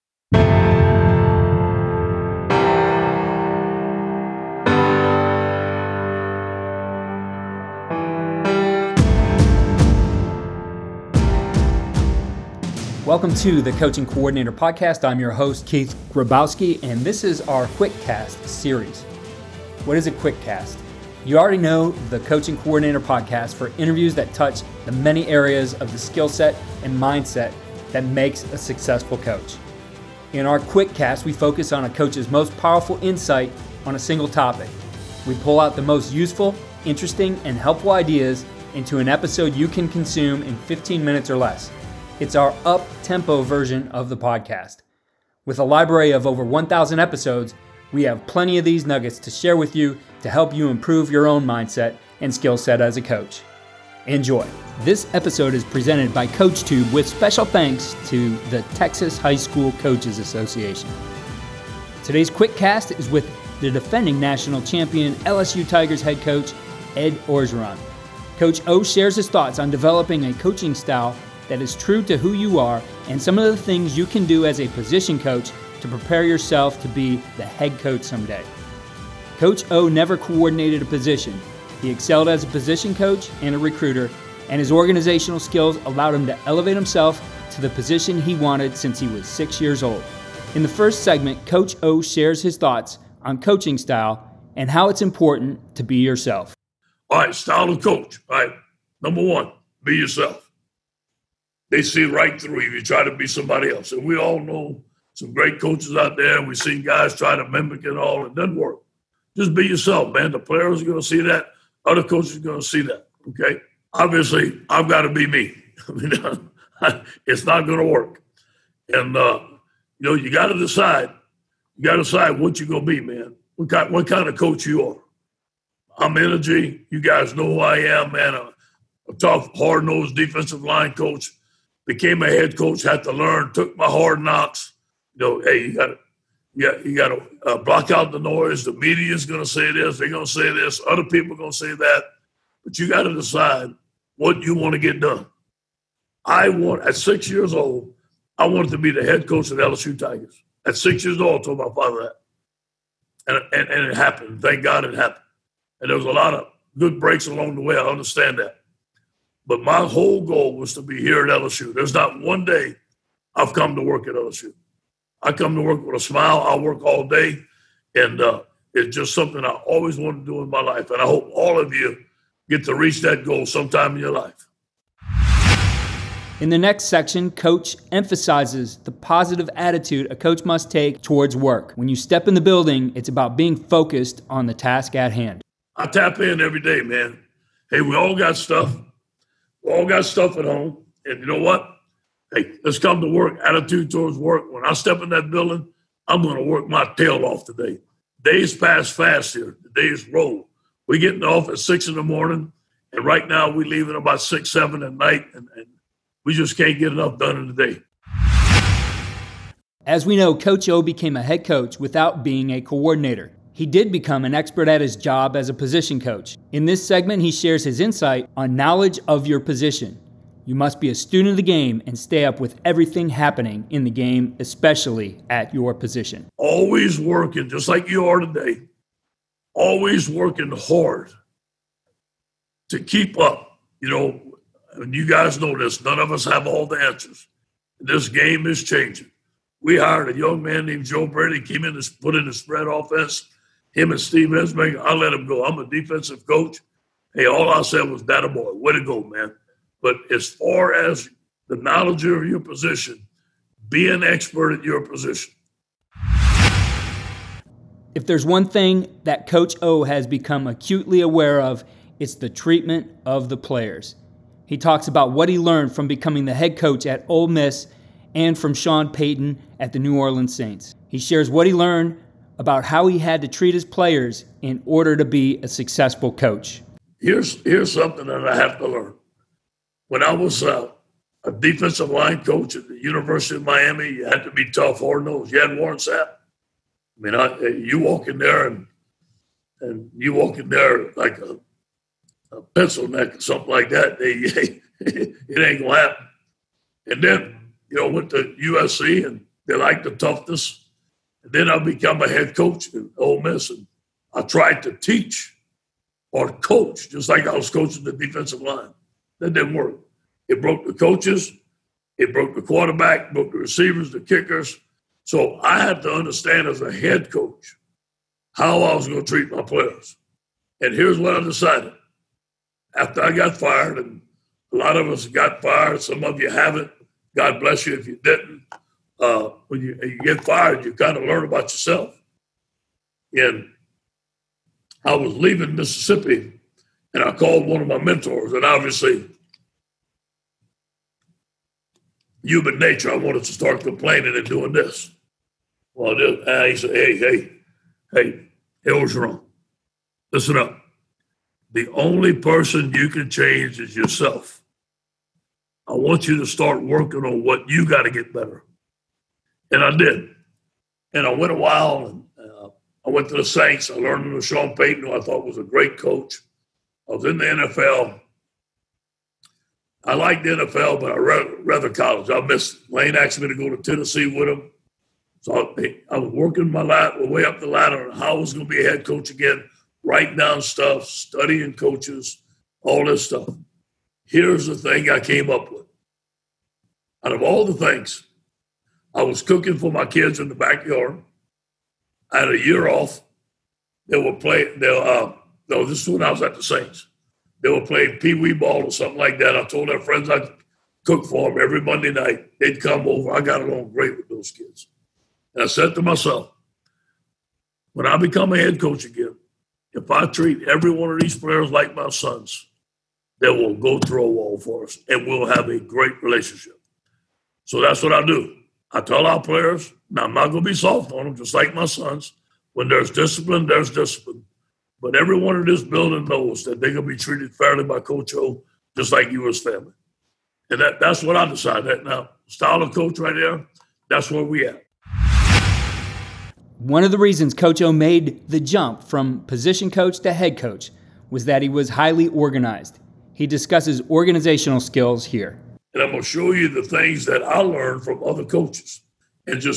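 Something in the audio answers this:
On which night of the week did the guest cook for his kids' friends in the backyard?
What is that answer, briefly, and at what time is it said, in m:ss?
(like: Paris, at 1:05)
Monday, at 6:41.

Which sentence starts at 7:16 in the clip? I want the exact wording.
One of the reasons Coach O made the jump from position coach to head coach was that he was highly organized.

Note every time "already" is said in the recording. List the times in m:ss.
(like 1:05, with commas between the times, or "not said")
0:21.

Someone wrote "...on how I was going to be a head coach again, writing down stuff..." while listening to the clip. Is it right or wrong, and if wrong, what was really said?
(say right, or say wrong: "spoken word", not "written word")
right.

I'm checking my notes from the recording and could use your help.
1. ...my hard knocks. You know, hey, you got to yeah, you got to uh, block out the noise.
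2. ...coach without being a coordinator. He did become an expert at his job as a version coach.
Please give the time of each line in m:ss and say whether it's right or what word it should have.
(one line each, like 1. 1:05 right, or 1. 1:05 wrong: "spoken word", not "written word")
1. 2:13 right
2. 3:31 wrong: "position", not "version".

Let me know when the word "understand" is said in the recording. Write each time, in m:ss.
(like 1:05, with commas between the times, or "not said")
2:37, 5:15.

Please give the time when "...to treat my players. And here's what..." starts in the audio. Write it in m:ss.
5:19.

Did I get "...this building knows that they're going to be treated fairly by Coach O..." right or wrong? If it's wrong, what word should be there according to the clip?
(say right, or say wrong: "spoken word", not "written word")
right.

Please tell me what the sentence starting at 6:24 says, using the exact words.
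Here's the thing I came up with.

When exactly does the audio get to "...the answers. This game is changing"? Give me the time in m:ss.
3:56.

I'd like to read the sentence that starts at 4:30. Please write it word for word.
He shares what he learned about how he had to treat his players in order to be a successful coach.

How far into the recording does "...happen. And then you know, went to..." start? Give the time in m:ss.
4:55.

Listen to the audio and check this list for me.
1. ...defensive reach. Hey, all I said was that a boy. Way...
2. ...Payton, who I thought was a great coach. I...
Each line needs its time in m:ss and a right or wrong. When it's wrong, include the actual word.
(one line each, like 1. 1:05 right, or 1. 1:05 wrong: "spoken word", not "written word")
1. 4:05 wrong: "coach", not "reach"
2. 6:04 right.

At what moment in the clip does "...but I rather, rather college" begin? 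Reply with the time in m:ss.
6:10.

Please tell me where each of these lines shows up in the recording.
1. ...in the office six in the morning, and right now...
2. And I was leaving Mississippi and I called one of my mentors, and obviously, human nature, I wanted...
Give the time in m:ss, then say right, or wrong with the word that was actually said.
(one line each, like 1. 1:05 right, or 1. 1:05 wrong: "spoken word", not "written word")
1. 3:21 right
2. 5:33 right.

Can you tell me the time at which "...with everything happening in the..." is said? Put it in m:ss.
3:42.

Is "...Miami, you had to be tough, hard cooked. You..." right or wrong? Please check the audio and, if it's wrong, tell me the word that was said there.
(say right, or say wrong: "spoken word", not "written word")
wrong: "nosed", not "cooked".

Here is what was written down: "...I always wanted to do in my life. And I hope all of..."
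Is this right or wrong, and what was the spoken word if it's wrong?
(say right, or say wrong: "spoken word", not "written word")
right.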